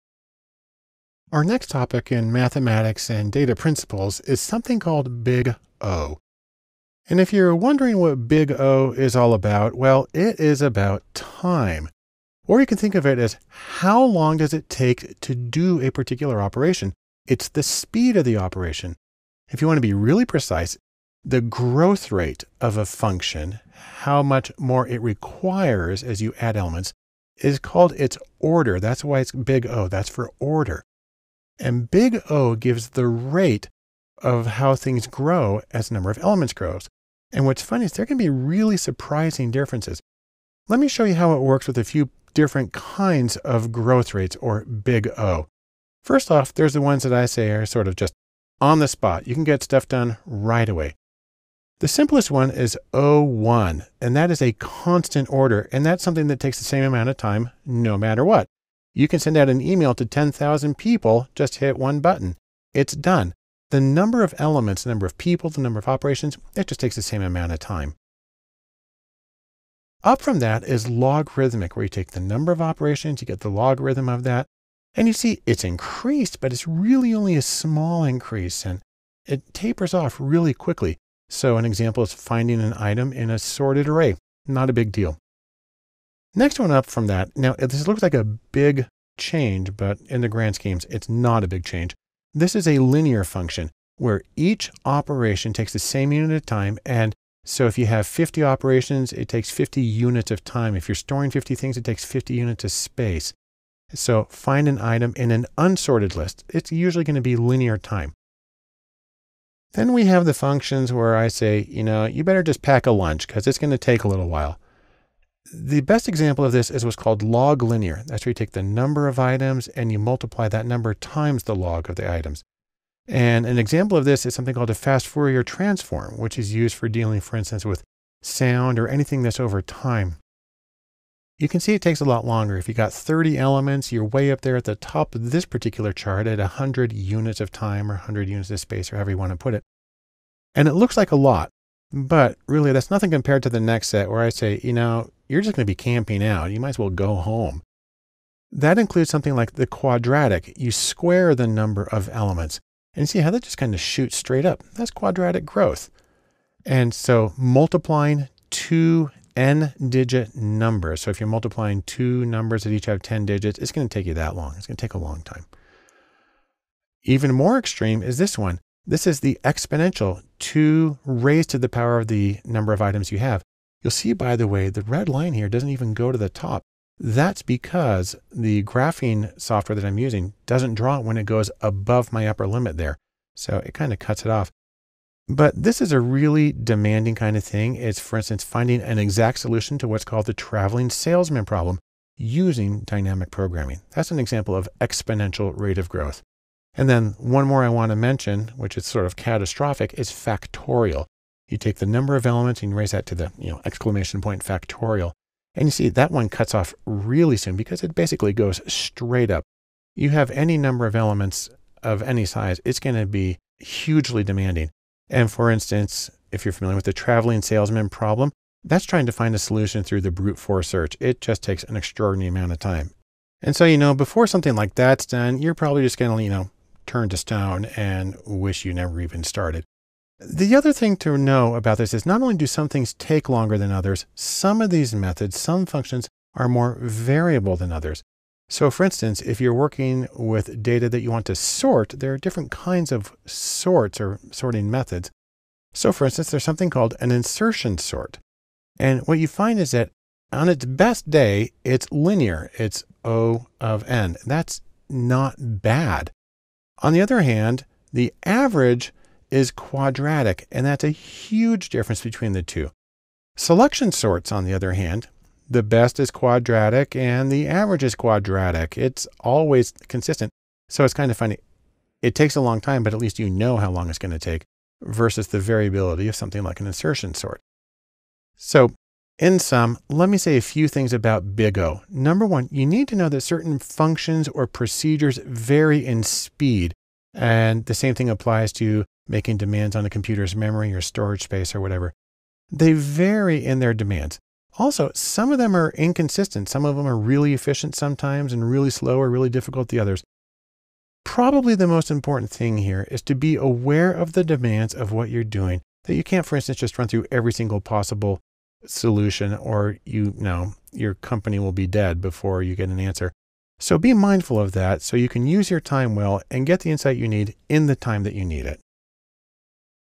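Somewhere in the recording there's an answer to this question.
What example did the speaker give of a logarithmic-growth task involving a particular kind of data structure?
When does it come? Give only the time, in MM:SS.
01:22.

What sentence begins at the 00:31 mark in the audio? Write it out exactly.
And big O gives the rate of how things grow as the number of elements grows.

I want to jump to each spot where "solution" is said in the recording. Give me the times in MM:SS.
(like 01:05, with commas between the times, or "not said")
03:09, 03:39, 05:08.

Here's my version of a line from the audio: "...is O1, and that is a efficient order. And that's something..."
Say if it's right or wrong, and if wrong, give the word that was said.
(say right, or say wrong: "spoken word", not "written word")
wrong: "constant", not "efficient".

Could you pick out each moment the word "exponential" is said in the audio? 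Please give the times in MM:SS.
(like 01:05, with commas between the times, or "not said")
02:49, 03:14.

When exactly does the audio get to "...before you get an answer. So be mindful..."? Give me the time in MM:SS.
05:12.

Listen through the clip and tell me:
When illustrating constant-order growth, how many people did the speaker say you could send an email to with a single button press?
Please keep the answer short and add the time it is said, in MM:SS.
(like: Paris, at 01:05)
10,000, at 01:00.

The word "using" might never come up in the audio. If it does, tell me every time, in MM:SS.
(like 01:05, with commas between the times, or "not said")
02:59, 03:12.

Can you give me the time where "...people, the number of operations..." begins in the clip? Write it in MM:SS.
01:05.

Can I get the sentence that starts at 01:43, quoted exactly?
So find an item in an unsorted list.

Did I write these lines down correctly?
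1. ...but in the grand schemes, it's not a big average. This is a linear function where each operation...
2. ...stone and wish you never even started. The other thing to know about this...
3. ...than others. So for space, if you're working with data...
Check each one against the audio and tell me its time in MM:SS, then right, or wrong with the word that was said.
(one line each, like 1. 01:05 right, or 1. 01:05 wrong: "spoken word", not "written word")
1. 01:29 wrong: "change", not "average"
2. 03:47 right
3. 03:57 wrong: "instance", not "space".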